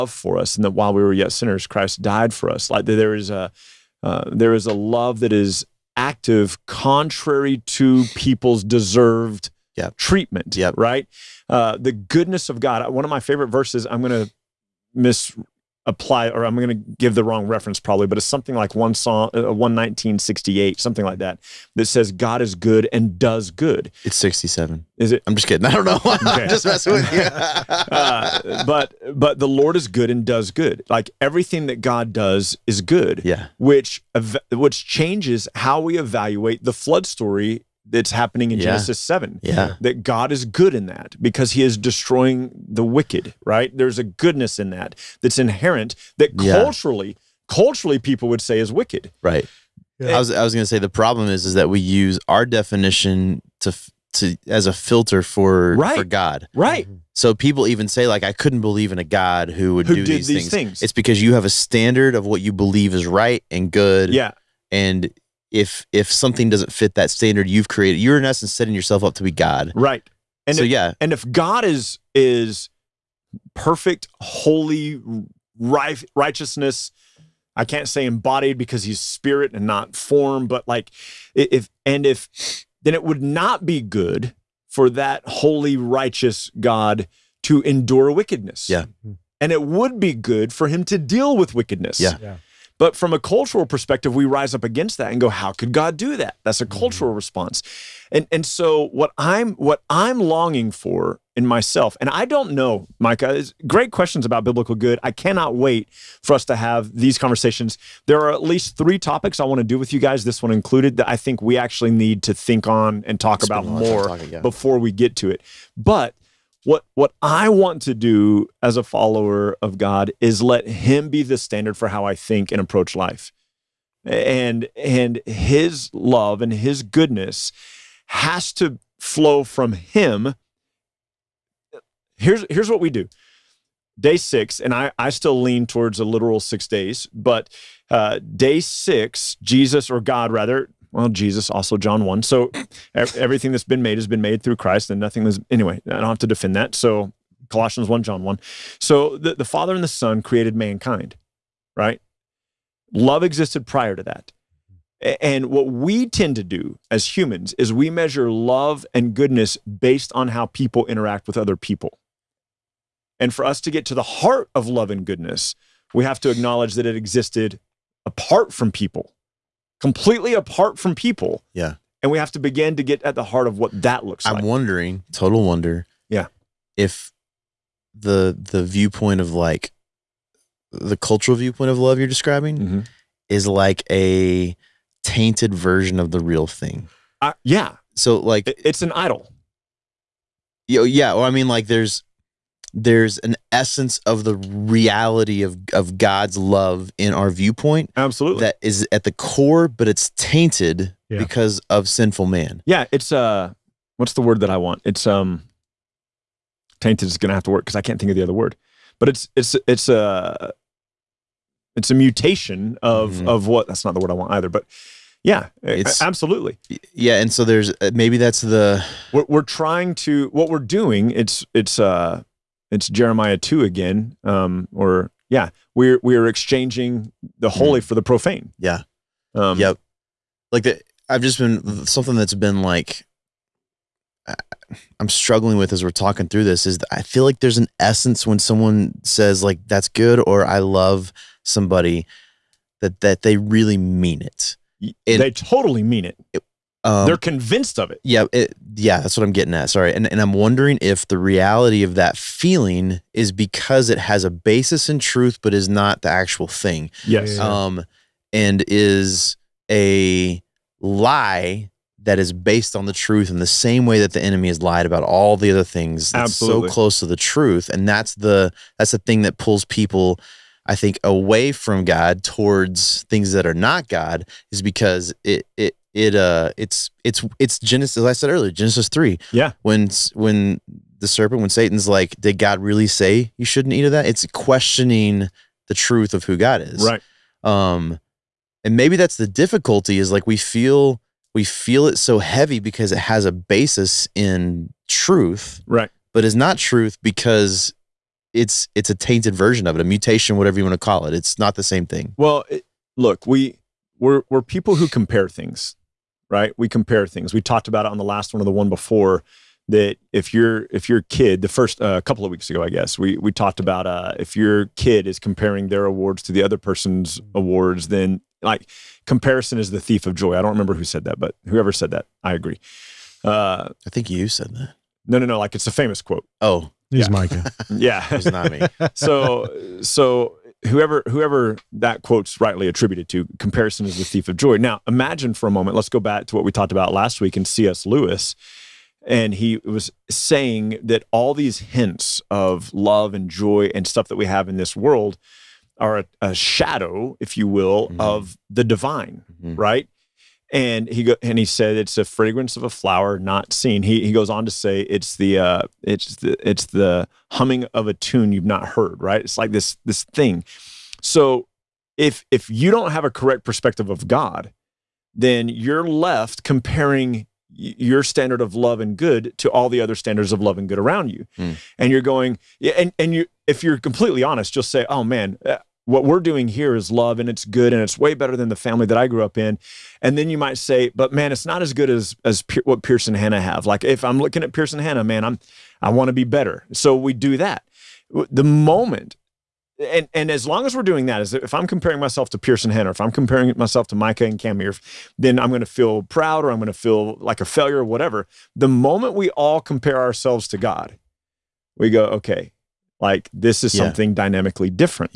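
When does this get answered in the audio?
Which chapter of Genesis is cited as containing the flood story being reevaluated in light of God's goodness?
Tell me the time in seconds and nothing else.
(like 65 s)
38 s.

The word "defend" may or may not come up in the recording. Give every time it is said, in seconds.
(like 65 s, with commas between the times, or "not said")
146 s.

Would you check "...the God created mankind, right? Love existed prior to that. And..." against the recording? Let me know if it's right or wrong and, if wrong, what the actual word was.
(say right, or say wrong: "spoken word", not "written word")
wrong: "Son", not "God".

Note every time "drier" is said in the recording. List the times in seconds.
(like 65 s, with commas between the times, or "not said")
not said.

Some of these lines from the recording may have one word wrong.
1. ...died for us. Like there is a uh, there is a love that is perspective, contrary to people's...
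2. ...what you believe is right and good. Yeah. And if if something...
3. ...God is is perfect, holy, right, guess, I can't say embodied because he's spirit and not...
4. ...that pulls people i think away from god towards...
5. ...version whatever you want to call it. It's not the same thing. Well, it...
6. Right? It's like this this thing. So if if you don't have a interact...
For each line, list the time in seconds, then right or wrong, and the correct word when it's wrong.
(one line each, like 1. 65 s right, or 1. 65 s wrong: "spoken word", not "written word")
1. 2 s wrong: "active", not "perspective"
2. 62 s right
3. 71 s wrong: "righteousness", not "guess"
4. 269 s right
5. 299 s wrong: "mutation", not "version"
6. 359 s wrong: "correct", not "interact".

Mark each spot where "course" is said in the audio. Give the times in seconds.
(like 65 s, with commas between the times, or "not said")
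not said.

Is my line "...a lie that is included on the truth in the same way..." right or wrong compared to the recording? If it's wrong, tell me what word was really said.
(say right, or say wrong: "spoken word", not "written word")
wrong: "based", not "included".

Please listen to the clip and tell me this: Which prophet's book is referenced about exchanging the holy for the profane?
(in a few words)
Jeremiah.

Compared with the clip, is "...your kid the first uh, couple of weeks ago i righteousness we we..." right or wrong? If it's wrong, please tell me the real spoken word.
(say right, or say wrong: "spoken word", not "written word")
wrong: "guess", not "righteousness".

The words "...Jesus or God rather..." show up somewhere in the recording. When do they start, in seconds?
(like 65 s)
139 s.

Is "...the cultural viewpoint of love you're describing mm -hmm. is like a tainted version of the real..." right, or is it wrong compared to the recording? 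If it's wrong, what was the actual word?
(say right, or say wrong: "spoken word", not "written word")
right.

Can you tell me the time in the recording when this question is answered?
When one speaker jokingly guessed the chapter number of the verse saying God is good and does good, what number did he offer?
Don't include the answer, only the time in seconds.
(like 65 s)
24 s.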